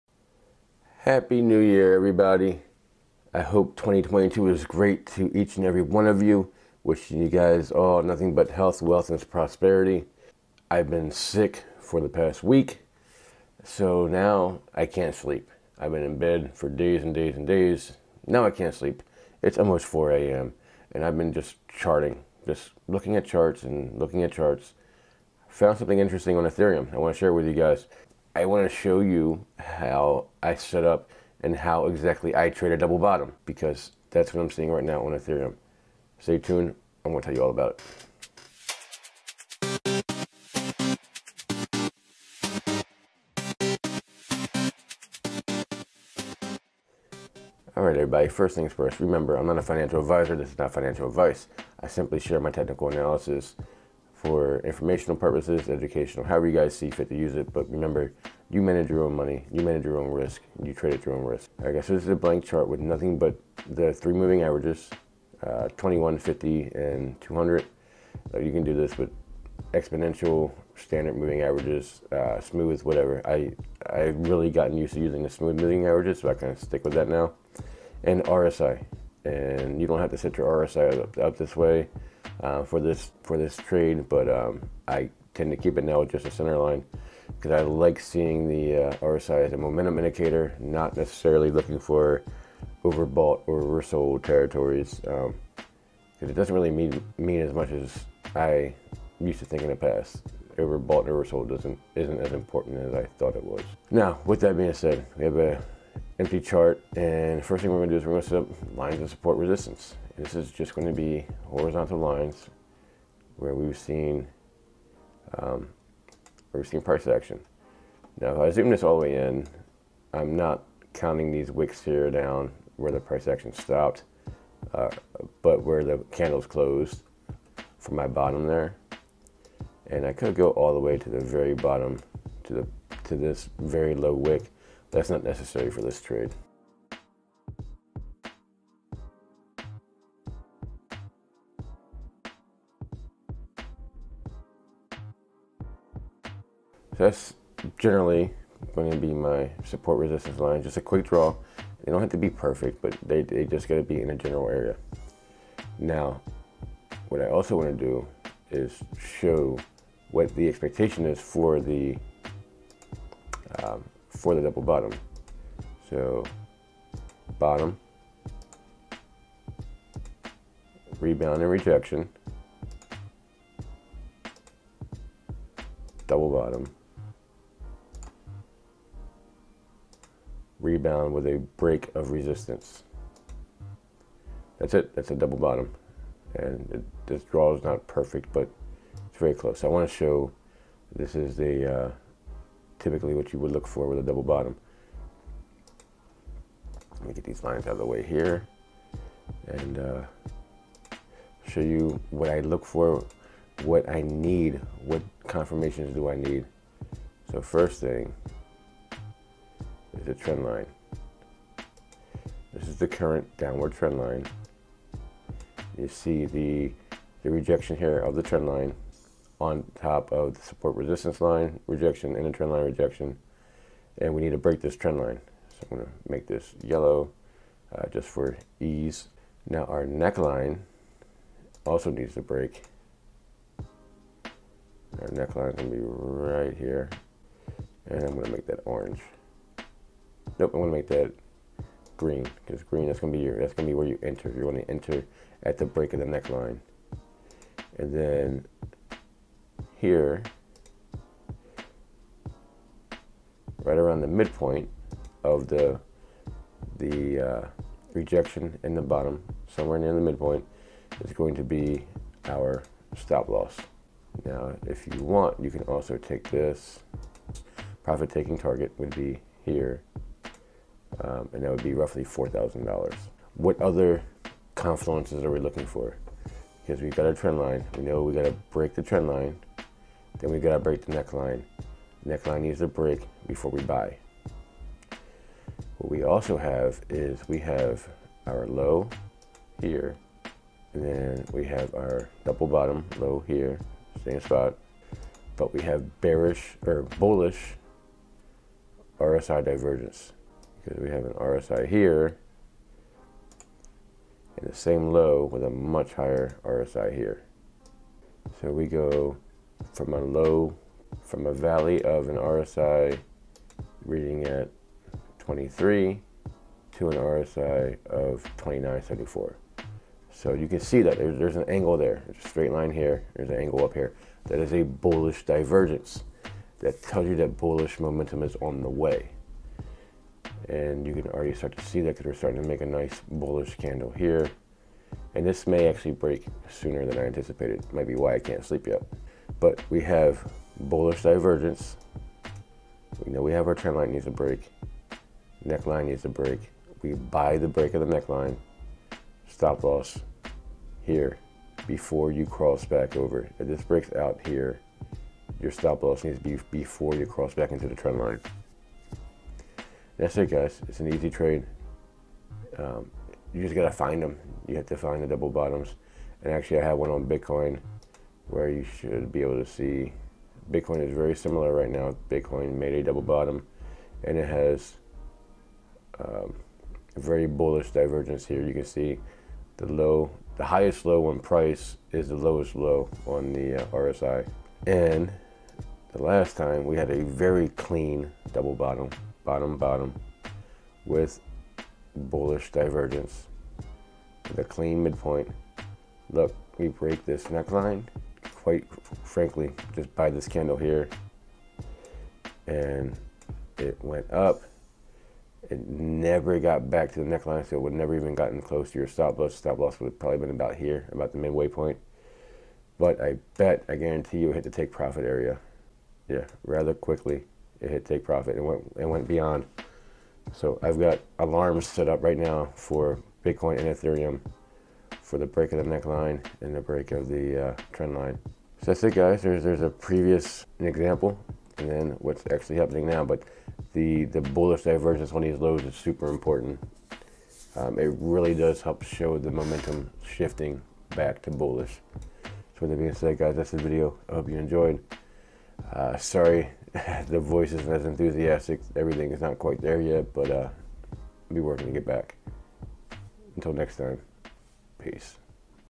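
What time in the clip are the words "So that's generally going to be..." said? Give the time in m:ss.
2:26.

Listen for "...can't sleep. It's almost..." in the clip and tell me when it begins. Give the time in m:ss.
0:18.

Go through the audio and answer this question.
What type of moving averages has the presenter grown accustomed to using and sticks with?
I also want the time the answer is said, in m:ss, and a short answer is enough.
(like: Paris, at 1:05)
Smooth moving averages, at 1:15.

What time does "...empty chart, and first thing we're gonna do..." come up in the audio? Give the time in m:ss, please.
1:46.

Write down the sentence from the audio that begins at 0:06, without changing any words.
Wishing you guys all nothing but health, wealth, and prosperity.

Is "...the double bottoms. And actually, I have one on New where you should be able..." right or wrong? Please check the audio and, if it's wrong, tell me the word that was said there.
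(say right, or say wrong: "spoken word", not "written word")
wrong: "Bitcoin", not "New".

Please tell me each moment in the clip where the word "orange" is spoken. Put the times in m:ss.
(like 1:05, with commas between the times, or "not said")
3:58.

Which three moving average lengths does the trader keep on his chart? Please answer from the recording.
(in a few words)
21, 50, and 200.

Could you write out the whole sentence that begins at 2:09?
And I could go all the way to the very bottom, to the to this very low wick.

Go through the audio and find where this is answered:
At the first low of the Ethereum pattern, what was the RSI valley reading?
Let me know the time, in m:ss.
5:15.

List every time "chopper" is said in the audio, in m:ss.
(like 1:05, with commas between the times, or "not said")
not said.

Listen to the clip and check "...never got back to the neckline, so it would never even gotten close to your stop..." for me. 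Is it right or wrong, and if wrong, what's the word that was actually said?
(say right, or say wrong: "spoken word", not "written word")
right.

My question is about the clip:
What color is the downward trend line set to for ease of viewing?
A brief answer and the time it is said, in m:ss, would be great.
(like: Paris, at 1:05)
Yellow, at 3:46.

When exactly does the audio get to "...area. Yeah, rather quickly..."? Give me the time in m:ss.
6:55.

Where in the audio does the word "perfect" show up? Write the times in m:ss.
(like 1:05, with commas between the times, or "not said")
2:32, 3:07.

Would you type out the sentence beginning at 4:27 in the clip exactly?
Profit taking target would be here um, and that would be roughly $4,000.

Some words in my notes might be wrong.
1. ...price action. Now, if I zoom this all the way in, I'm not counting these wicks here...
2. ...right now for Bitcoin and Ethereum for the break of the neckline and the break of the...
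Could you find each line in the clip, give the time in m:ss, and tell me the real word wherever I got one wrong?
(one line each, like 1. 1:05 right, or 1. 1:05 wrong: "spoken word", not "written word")
1. 1:56 right
2. 7:02 right.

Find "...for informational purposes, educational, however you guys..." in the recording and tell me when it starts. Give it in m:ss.
0:54.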